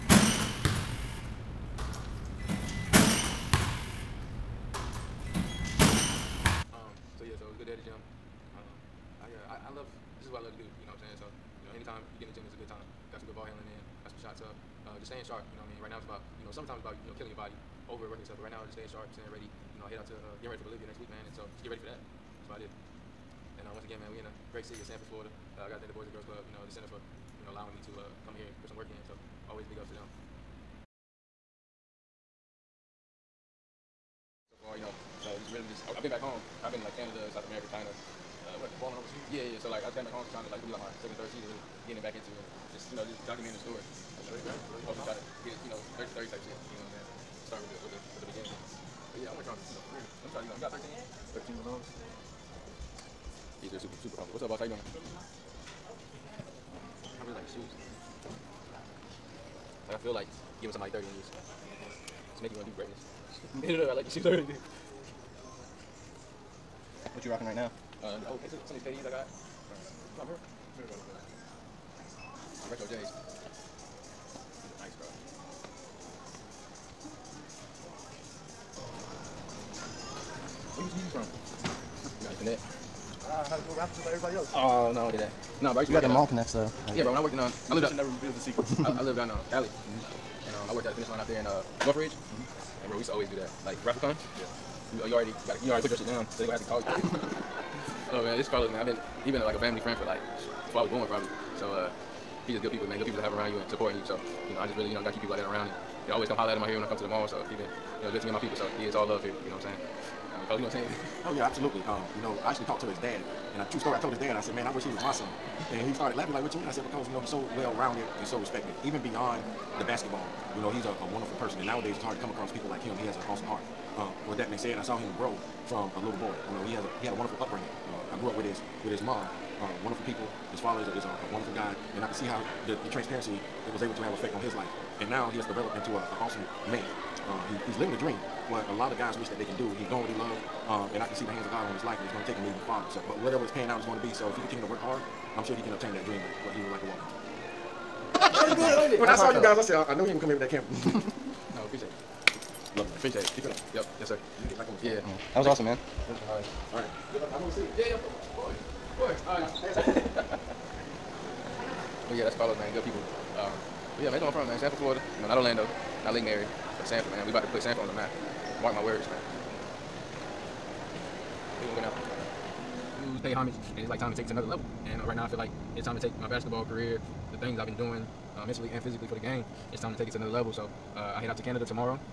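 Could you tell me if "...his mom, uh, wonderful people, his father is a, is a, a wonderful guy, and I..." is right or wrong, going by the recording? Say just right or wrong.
right.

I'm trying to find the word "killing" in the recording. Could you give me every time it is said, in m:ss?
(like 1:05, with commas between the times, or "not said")
0:17.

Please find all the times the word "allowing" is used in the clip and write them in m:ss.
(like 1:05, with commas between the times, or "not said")
0:27.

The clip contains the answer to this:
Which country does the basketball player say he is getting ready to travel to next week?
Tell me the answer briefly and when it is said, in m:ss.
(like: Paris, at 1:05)
Bolivia, at 0:20.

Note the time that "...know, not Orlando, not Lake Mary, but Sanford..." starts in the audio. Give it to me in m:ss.
2:45.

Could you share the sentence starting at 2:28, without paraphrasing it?
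good, When That's I saw you guys, I said, uh, I, I, know he ain't gonna come here with that camera.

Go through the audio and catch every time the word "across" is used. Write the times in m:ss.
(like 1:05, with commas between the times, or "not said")
2:02.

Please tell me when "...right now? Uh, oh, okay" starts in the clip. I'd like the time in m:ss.
1:07.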